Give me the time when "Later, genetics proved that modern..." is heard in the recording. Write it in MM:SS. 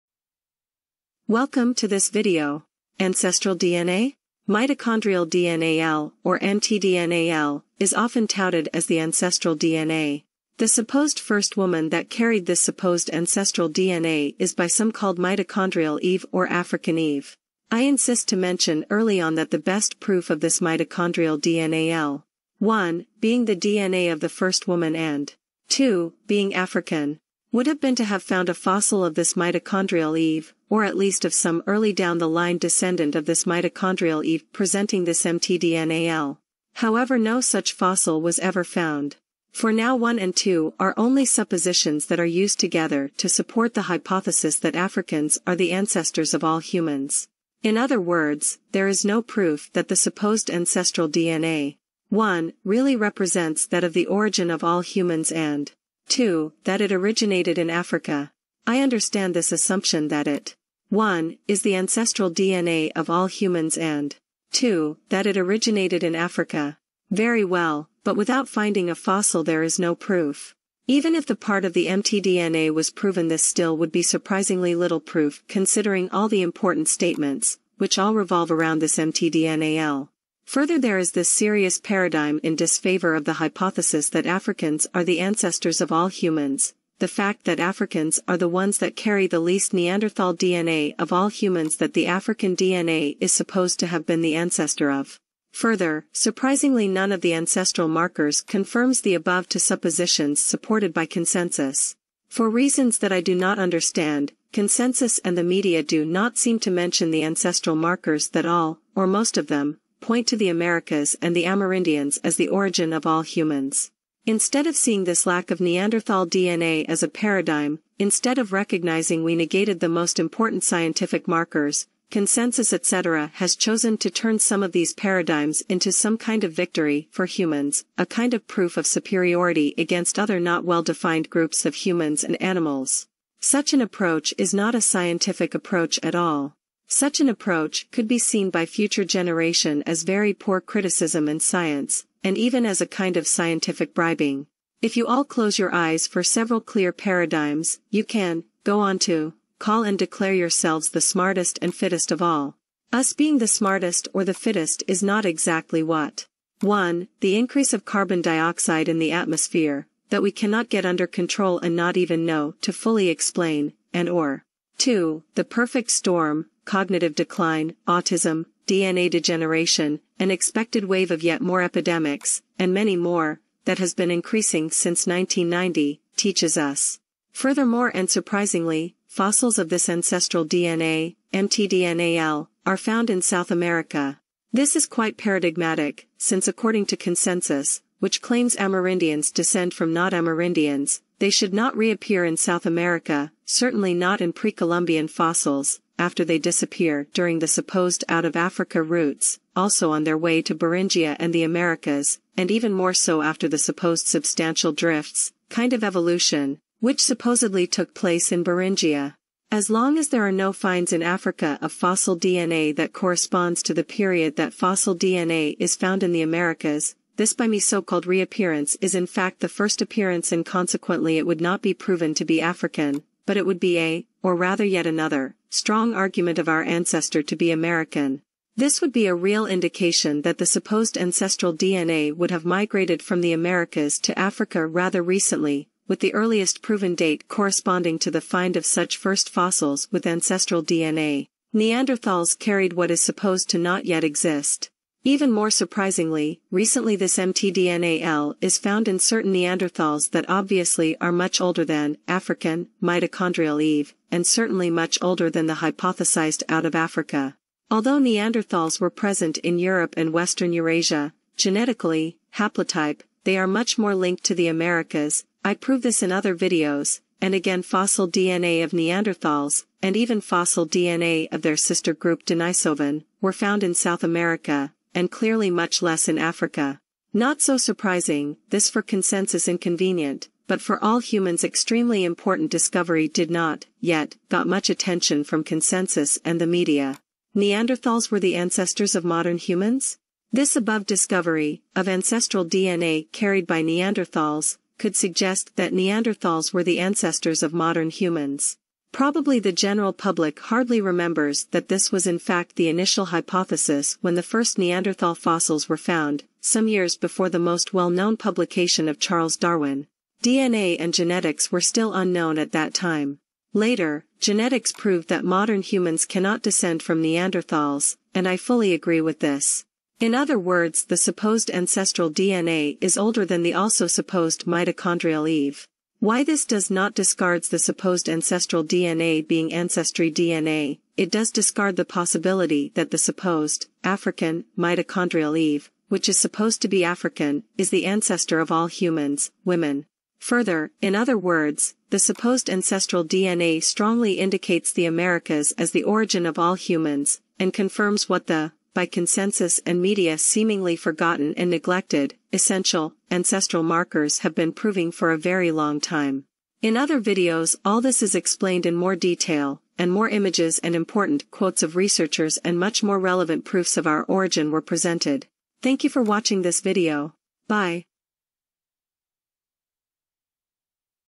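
05:13.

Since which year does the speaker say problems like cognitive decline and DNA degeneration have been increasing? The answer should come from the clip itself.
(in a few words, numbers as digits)
1990.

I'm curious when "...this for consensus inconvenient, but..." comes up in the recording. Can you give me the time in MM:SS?
04:38.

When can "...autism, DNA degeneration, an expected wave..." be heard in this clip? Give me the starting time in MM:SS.
02:47.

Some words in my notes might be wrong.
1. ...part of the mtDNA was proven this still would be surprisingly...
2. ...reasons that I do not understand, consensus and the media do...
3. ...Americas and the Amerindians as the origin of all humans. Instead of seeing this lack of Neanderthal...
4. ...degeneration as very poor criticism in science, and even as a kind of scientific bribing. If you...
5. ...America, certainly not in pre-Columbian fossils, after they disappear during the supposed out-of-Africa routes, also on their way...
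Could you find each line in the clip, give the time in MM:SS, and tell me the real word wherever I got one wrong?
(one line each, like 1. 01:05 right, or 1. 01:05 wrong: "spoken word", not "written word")
1. 01:11 right
2. 01:42 right
3. 01:50 right
4. 02:19 wrong: "generation", not "degeneration"
5. 03:12 right.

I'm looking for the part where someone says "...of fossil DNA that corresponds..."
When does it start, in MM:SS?
03:31.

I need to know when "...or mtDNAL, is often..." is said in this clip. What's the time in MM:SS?
00:06.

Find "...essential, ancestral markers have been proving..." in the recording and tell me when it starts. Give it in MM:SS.
05:52.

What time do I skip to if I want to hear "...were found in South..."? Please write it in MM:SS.
04:33.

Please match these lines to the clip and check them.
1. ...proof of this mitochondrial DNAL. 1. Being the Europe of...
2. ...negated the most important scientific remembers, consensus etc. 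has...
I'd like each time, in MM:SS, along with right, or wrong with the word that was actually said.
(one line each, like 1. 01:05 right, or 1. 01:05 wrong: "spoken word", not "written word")
1. 00:20 wrong: "DNA", not "Europe"
2. 01:59 wrong: "markers", not "remembers".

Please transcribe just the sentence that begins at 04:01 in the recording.
Neanderthals carried what is supposed to not yet exist.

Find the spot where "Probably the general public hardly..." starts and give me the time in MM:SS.
04:58.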